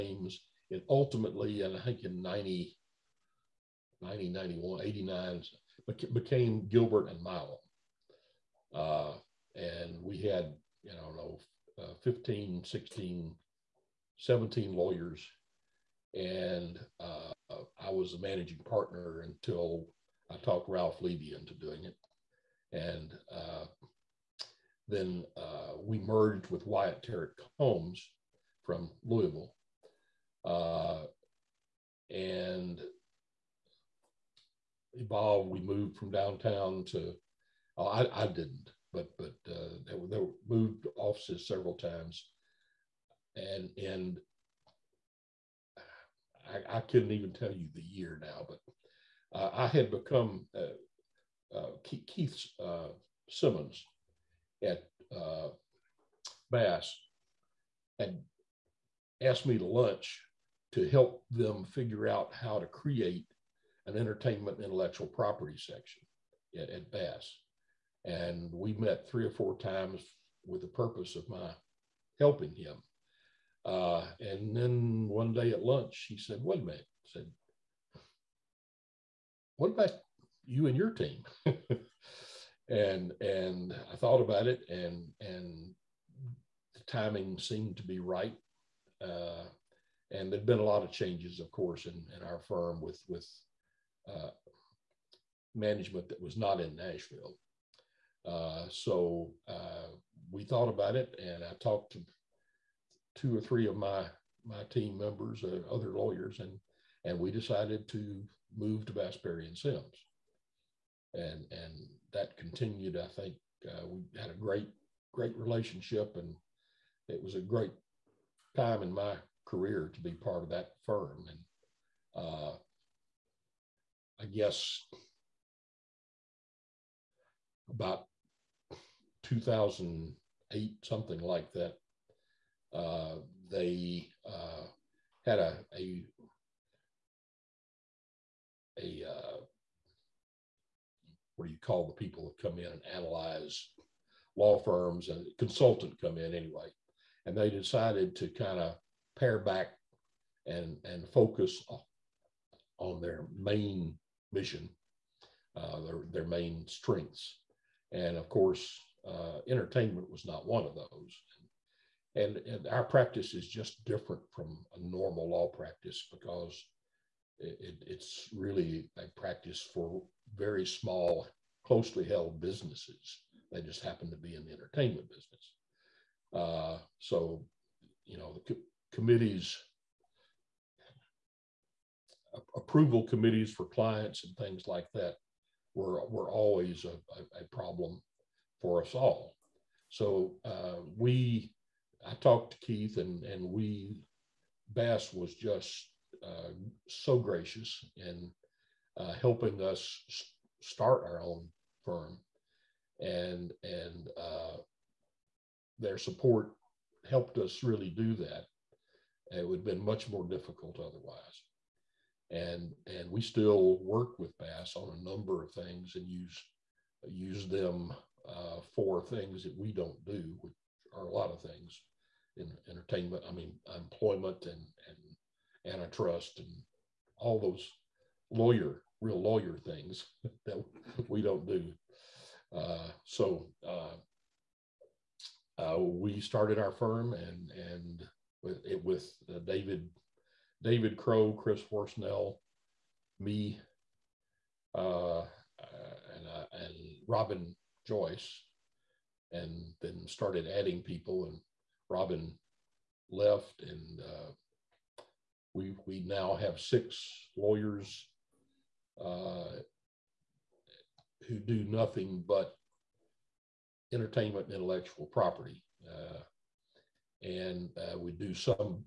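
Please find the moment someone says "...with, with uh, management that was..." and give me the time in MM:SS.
01:32.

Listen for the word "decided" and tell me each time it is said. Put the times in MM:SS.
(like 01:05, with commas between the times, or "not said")
01:47, 02:27.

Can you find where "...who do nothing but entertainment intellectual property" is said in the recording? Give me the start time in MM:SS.
04:21.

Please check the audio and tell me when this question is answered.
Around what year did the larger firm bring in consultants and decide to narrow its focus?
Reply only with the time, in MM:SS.
02:09.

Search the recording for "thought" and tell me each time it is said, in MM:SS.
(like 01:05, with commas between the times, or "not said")
01:23, 01:40.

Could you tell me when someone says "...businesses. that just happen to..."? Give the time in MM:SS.
02:52.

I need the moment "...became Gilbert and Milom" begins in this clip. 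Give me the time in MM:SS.
00:06.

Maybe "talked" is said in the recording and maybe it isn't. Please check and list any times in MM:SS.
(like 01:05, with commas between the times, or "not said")
00:20, 01:41, 03:12.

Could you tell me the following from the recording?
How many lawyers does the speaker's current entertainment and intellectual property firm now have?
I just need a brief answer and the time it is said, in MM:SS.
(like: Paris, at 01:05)
6, at 04:16.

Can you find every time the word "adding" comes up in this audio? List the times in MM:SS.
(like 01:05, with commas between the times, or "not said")
04:10.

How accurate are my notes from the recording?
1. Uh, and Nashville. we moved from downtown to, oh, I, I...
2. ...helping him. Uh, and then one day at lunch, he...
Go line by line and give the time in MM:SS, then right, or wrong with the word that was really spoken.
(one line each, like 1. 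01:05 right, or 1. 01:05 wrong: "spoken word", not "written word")
1. 00:30 wrong: "Evolved", not "Nashville"
2. 01:12 right.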